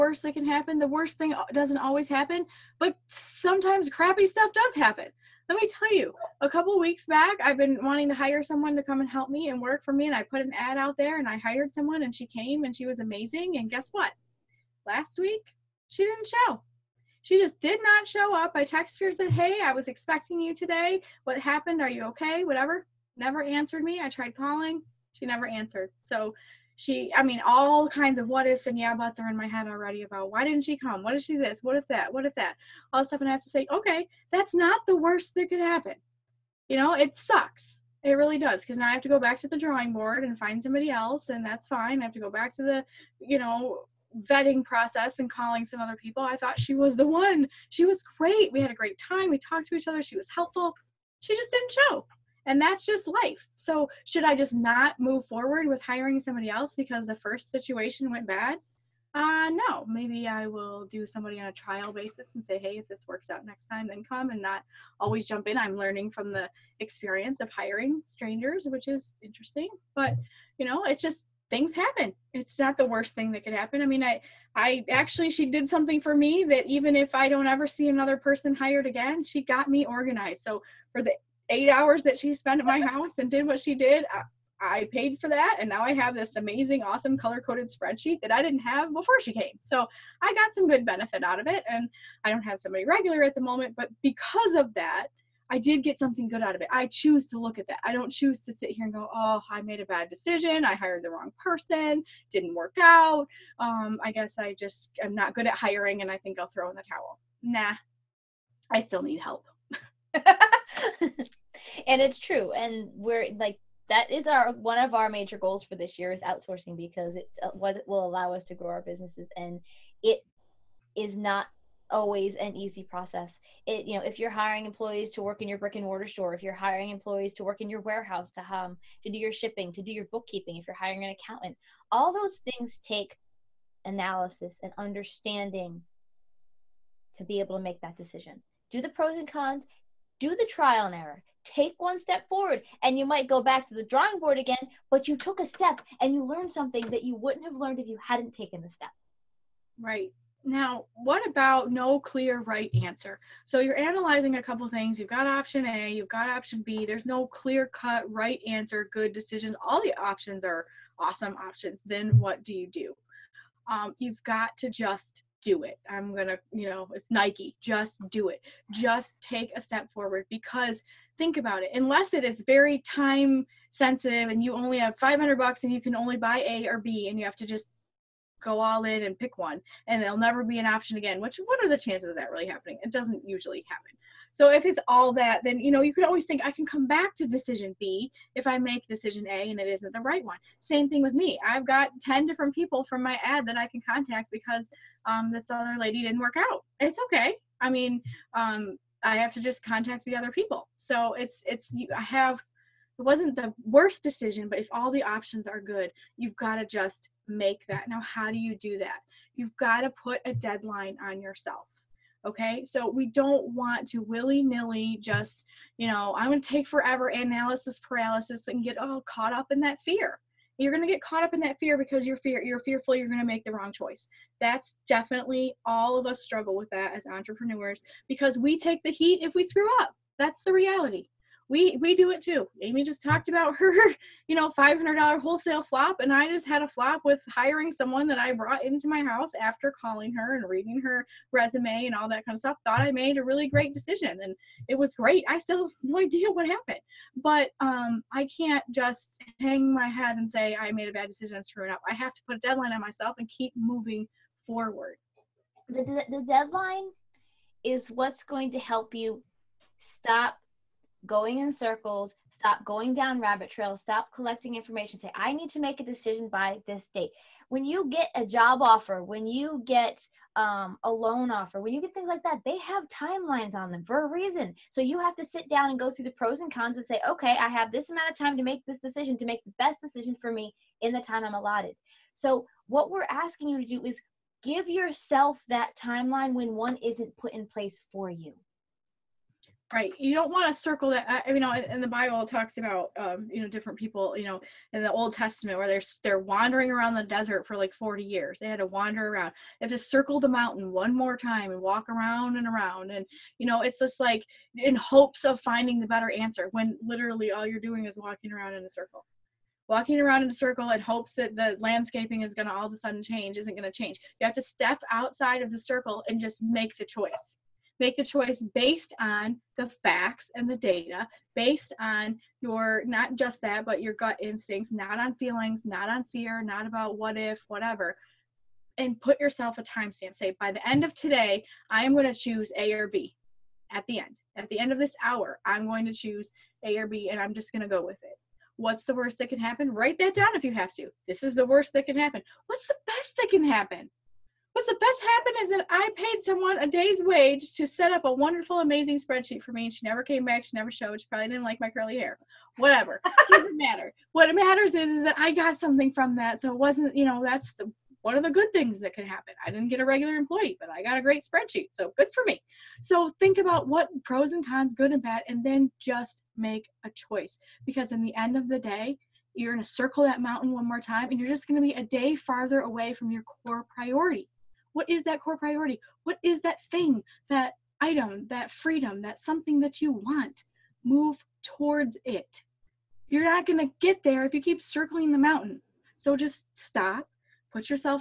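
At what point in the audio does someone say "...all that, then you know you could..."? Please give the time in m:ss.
3:04.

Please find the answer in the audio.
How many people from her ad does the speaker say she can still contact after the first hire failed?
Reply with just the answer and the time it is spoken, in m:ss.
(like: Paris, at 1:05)
10, at 3:12.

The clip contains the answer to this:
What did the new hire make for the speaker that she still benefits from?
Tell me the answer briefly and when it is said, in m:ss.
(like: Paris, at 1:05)
color coded spreadsheet, at 1:27.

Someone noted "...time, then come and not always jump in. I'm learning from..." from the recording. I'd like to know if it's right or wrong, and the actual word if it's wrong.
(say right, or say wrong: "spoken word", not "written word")
right.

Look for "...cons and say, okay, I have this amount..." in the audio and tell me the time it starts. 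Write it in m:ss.
4:36.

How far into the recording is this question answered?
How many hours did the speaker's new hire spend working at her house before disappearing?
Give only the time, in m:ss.
1:21.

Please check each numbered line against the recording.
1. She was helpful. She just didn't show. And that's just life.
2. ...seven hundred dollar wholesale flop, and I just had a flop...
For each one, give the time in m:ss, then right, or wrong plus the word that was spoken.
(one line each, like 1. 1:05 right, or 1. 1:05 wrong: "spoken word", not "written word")
1. 0:50 right
2. 3:54 wrong: "five", not "seven".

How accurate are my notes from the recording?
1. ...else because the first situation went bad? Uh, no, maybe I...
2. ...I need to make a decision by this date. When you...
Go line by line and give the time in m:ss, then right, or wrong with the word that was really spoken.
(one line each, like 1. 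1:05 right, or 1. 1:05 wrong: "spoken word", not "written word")
1. 0:56 right
2. 4:25 right.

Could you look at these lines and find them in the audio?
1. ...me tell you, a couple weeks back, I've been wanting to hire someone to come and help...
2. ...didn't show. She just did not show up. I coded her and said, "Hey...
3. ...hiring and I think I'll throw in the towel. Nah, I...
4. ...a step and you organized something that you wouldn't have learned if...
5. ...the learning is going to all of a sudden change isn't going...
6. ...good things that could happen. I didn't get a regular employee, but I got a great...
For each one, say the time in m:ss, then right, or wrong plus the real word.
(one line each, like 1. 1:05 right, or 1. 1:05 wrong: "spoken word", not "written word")
1. 0:05 right
2. 0:16 wrong: "texted", not "coded"
3. 1:45 right
4. 2:25 wrong: "learned", not "organized"
5. 5:11 wrong: "landscaping", not "learning"
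6. 5:58 right.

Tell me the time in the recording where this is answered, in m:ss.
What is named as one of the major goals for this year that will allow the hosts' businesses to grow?
1:56.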